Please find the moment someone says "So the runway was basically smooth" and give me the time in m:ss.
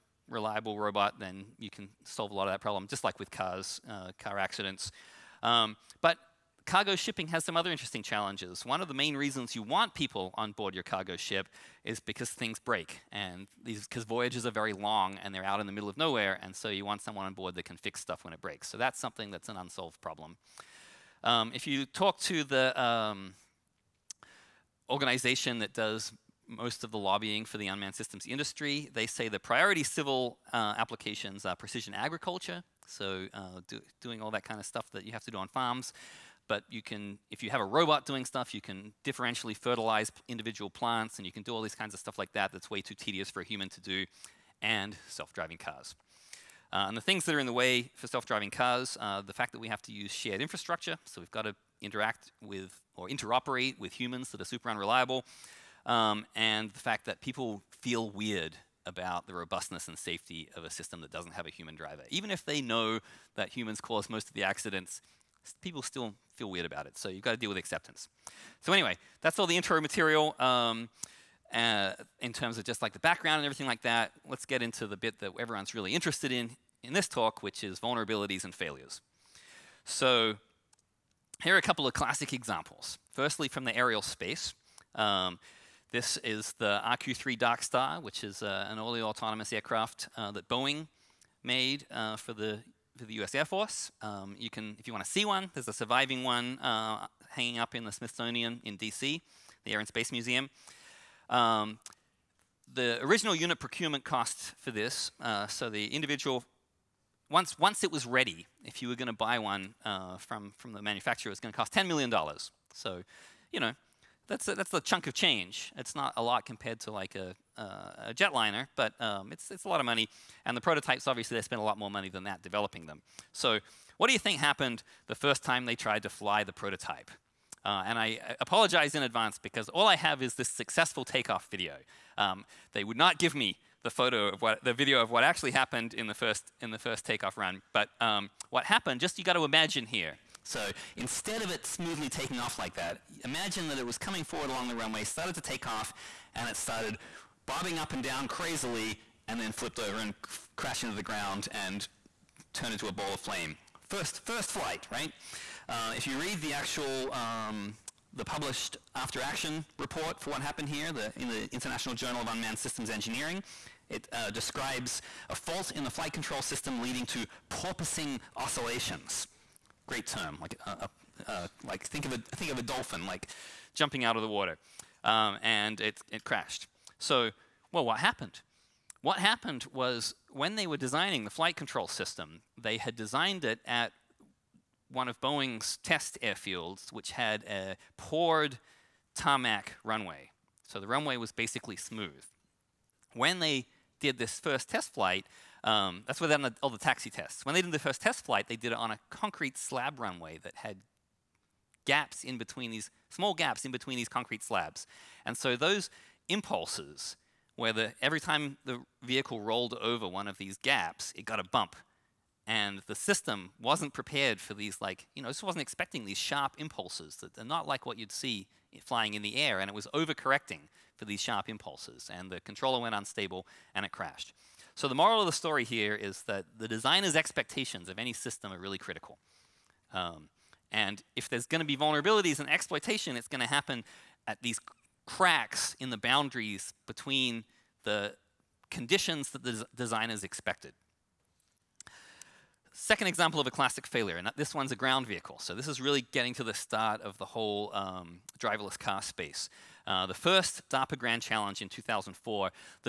3:10.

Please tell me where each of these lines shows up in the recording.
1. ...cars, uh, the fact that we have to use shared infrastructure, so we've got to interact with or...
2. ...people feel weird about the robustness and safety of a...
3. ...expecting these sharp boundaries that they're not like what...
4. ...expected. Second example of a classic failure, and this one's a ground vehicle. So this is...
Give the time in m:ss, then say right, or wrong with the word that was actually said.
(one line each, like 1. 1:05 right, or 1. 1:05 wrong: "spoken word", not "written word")
1. 0:48 right
2. 0:57 right
3. 3:35 wrong: "impulses", not "boundaries"
4. 4:00 right.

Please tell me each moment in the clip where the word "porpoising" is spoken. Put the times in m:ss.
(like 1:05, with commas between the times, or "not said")
2:47.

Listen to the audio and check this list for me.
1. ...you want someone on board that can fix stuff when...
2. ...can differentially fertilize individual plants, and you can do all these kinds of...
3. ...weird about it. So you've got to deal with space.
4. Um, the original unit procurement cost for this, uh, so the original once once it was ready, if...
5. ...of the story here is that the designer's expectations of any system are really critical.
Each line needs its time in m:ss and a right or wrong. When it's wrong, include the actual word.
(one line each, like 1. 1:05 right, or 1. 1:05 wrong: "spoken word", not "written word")
1. 0:16 right
2. 0:38 right
3. 1:06 wrong: "acceptance", not "space"
4. 1:41 wrong: "individual", not "original"
5. 3:45 right.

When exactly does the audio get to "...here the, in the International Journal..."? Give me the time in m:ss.
2:40.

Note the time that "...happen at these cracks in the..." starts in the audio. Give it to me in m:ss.
3:53.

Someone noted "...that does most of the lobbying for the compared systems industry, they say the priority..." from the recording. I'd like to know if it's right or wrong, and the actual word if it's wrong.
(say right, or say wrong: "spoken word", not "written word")
wrong: "unmanned", not "compared".